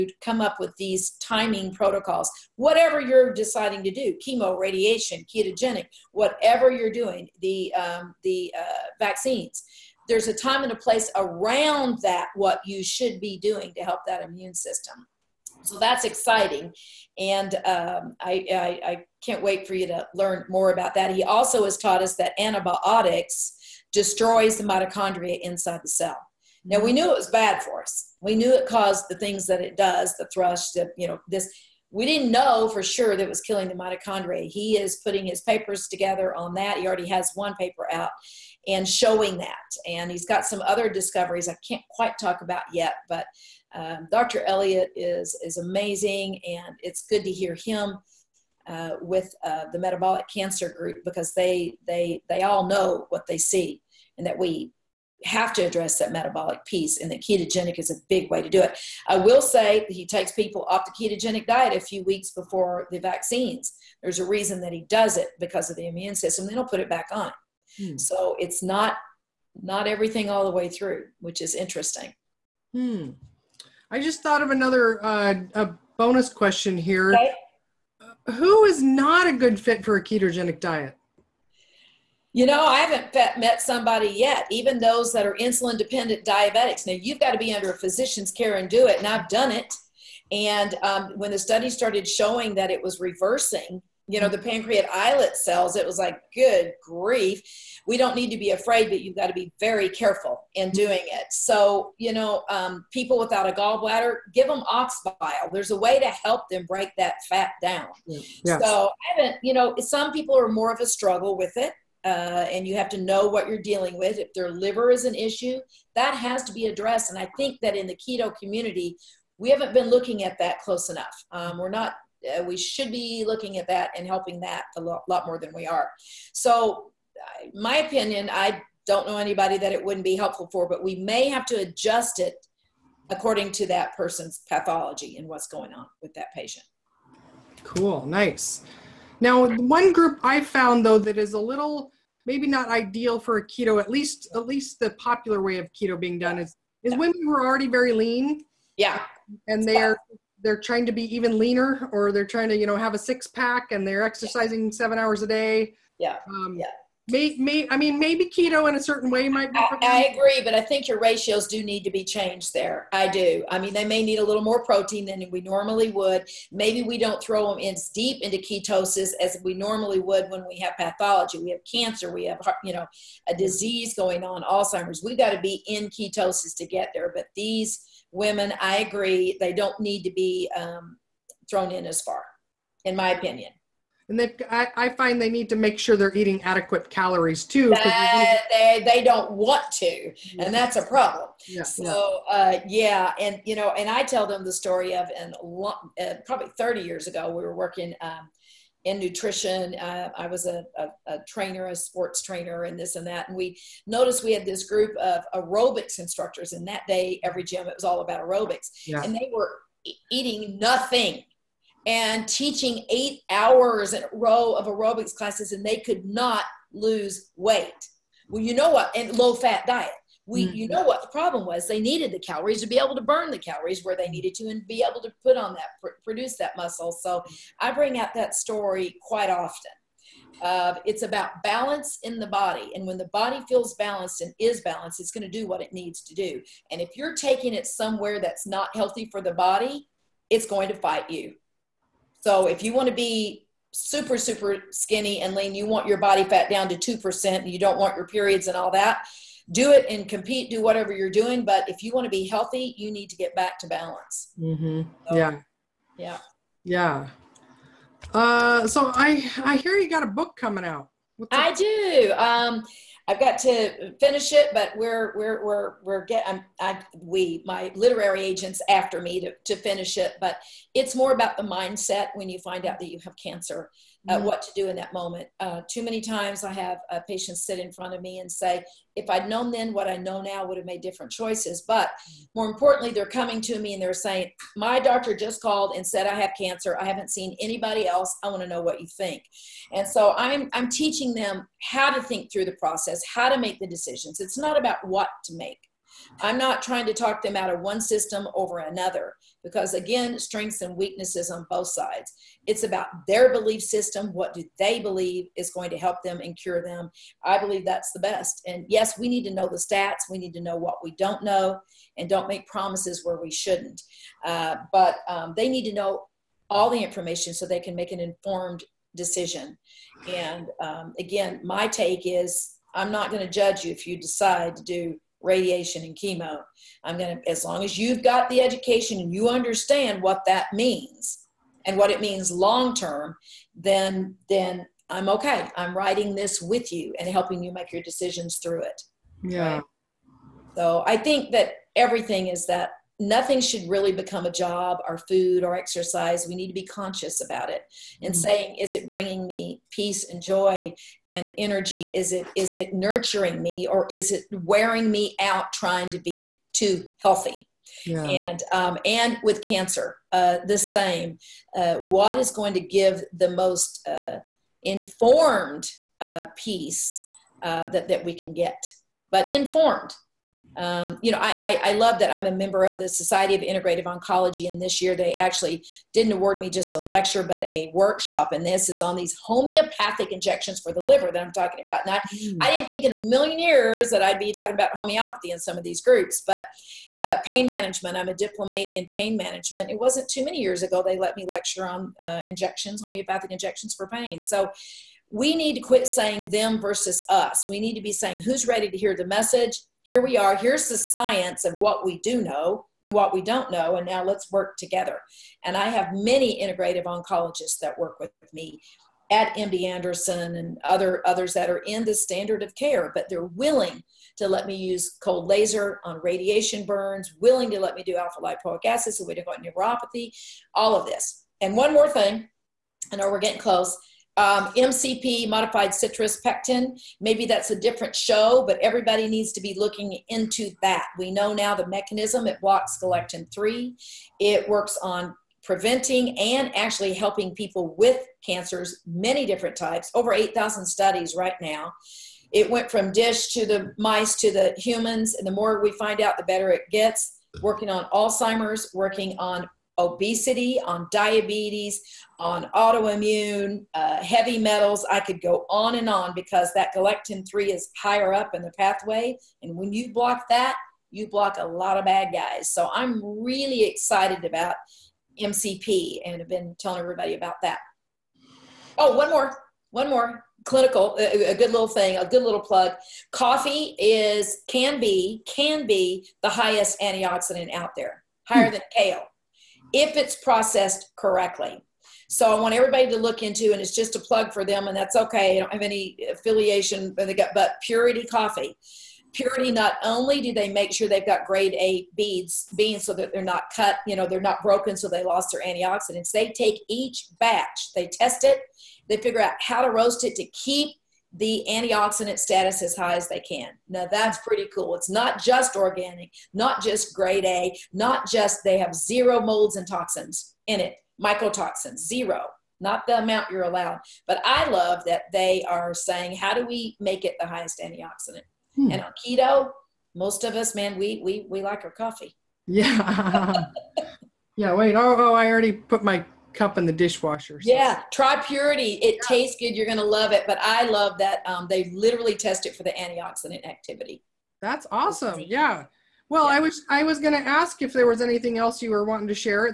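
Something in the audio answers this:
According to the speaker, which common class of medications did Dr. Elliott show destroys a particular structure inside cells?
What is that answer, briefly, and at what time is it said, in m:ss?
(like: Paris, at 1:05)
Antibiotics, at 0:22.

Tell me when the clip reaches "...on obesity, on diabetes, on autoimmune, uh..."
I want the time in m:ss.
7:29.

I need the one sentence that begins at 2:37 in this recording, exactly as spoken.
I mean, maybe keto in a certain way might be.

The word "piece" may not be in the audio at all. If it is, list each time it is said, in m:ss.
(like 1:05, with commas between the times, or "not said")
0:56, 6:06.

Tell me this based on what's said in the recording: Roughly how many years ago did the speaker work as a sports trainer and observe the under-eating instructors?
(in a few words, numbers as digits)
30.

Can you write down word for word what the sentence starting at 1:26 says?
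Now, you've got to be under a physician's care and do it, and I've done it.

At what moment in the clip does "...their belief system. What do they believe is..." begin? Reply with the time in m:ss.
5:03.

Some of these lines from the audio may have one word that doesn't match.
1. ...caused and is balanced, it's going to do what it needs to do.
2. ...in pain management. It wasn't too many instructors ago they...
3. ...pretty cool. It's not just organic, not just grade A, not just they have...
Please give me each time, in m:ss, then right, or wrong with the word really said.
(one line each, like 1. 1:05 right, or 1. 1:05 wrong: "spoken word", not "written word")
1. 3:53 wrong: "balanced", not "caused"
2. 6:28 wrong: "years", not "instructors"
3. 8:24 right.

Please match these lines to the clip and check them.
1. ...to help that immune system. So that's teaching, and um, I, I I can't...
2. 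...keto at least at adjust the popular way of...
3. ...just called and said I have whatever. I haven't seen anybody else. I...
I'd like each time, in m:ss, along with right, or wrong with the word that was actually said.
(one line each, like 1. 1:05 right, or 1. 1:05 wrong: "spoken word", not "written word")
1. 0:13 wrong: "exciting", not "teaching"
2. 2:23 wrong: "least", not "adjust"
3. 4:45 wrong: "cancer", not "whatever".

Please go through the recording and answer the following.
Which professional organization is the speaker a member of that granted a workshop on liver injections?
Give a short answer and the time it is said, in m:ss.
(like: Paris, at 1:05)
Society of Integrative Oncology, at 6:12.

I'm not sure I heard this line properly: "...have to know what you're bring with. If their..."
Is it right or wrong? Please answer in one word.
wrong.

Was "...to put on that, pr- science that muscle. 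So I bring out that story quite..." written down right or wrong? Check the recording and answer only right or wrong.
wrong.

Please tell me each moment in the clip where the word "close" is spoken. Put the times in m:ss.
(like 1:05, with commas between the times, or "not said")
2:00, 7:03.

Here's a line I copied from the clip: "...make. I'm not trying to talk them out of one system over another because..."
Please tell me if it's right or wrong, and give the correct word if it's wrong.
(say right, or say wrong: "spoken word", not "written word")
right.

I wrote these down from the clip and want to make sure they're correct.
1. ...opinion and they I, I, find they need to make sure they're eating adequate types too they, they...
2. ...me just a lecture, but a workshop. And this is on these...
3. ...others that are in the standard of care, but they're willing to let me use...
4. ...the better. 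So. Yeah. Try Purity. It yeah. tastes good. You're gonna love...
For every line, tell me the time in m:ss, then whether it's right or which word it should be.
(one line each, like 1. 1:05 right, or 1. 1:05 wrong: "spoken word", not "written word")
1. 3:03 wrong: "calories", not "types"
2. 6:16 right
3. 6:51 right
4. 8:46 wrong: "dishwasher", not "better".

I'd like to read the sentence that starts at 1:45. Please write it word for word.
There's a way to help them break that fat down.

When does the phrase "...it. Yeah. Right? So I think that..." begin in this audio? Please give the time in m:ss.
5:38.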